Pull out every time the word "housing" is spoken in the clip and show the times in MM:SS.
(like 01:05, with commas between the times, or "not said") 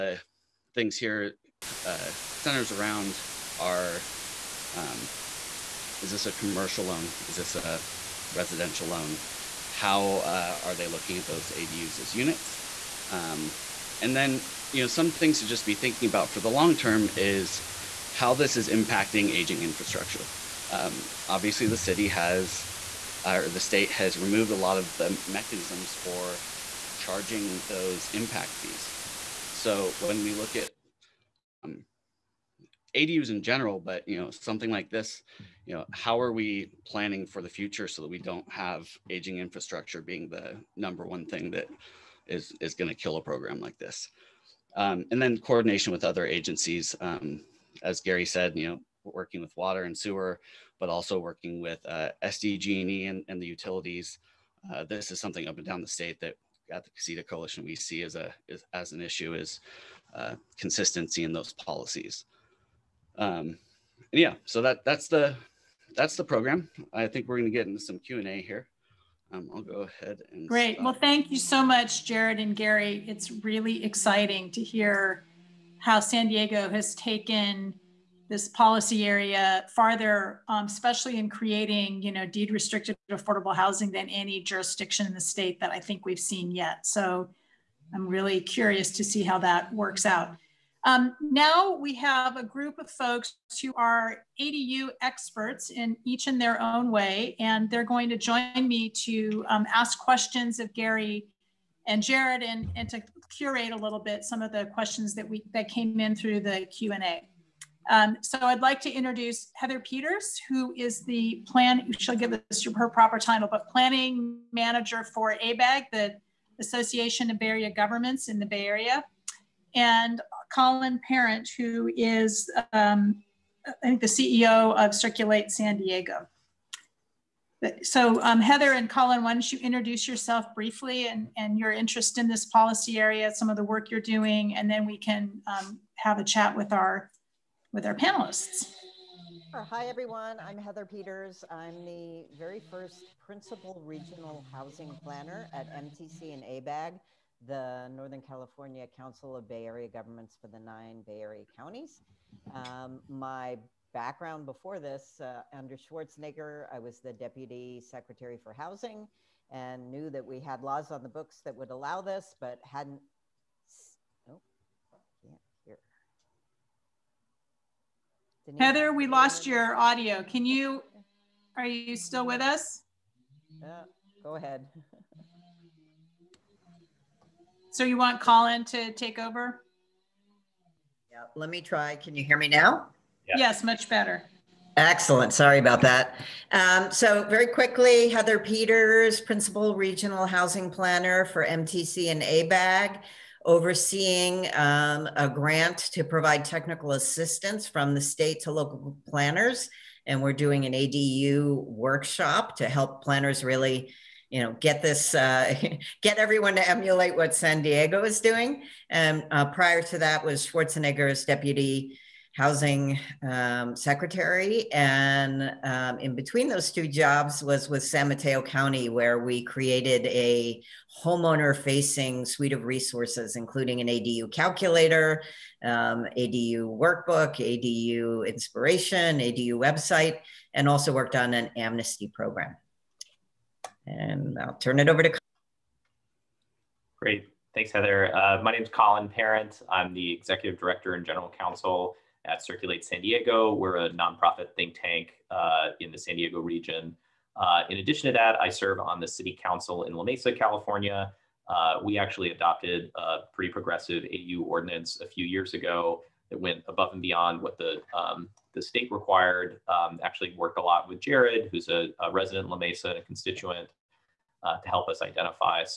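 01:23, 02:24, 02:38, 03:10, 03:32.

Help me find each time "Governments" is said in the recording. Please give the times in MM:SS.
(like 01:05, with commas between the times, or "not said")
01:57, 02:29.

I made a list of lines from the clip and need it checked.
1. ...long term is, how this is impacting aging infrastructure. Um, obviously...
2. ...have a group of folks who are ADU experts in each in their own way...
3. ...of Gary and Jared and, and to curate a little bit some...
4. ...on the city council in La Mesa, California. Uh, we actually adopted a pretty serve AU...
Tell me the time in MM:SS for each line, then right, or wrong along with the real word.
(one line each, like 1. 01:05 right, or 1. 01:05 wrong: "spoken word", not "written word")
1. 00:16 right
2. 01:31 right
3. 01:40 right
4. 04:08 wrong: "progressive", not "serve".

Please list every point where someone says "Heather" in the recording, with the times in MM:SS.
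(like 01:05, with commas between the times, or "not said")
01:49, 02:08, 02:20, 02:48, 03:08, 03:57.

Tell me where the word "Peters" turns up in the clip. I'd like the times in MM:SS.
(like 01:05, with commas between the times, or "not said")
01:49, 02:20, 03:08.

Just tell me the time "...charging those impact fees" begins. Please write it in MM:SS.
00:26.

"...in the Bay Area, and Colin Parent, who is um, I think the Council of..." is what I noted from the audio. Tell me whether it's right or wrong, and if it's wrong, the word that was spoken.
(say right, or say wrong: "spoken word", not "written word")
wrong: "CEO", not "Council".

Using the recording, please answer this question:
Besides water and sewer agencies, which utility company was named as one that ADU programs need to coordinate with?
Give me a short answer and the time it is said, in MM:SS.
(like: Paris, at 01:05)
SDG&E, at 00:52.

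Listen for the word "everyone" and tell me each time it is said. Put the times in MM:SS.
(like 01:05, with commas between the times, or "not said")
02:19, 03:26.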